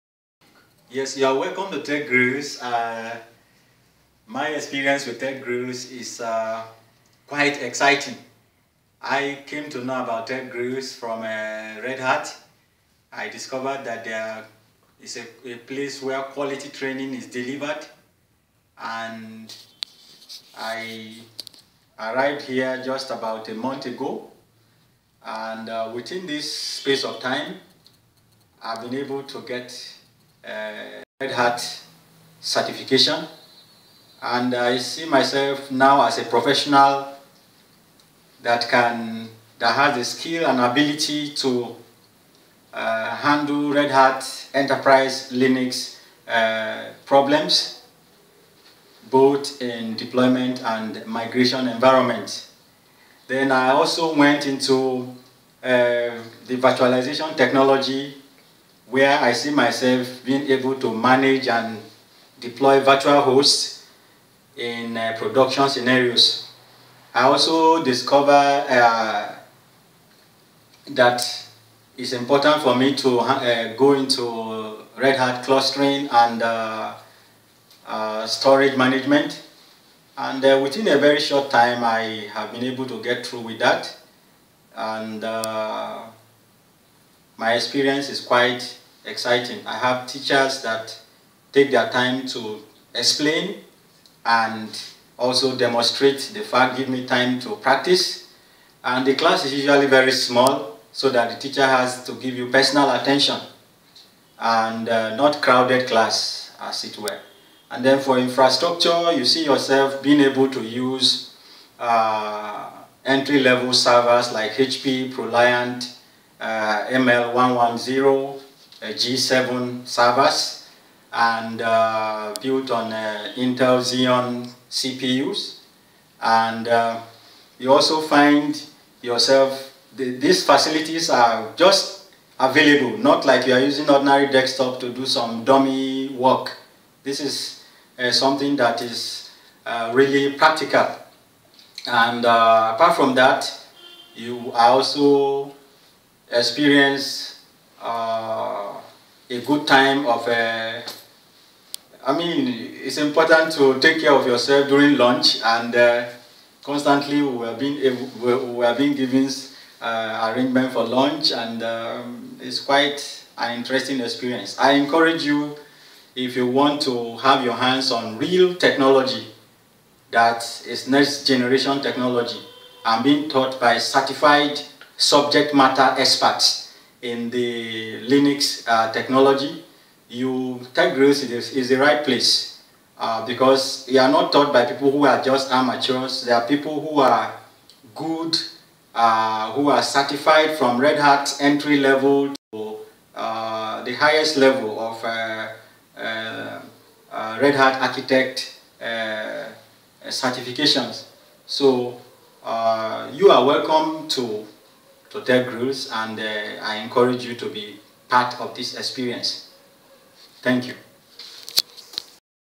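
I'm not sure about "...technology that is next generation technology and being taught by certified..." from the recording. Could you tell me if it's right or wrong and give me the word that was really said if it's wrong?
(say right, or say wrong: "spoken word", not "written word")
right.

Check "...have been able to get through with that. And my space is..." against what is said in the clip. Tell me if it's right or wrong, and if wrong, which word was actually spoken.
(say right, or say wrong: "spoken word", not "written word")
wrong: "experience", not "space".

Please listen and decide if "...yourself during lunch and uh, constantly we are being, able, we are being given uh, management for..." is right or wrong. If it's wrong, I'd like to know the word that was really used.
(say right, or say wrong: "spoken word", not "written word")
wrong: "arrangement", not "management".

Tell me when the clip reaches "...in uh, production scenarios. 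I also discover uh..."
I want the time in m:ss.
1:04.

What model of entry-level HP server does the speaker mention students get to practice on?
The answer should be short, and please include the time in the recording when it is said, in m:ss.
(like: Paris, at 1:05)
ProLiant ML110 G7, at 1:55.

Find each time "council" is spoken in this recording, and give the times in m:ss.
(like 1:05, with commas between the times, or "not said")
not said.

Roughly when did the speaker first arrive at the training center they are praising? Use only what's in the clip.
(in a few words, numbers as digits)
about a month ago.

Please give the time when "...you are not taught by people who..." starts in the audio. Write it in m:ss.
3:03.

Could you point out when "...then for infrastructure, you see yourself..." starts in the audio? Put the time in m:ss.
1:47.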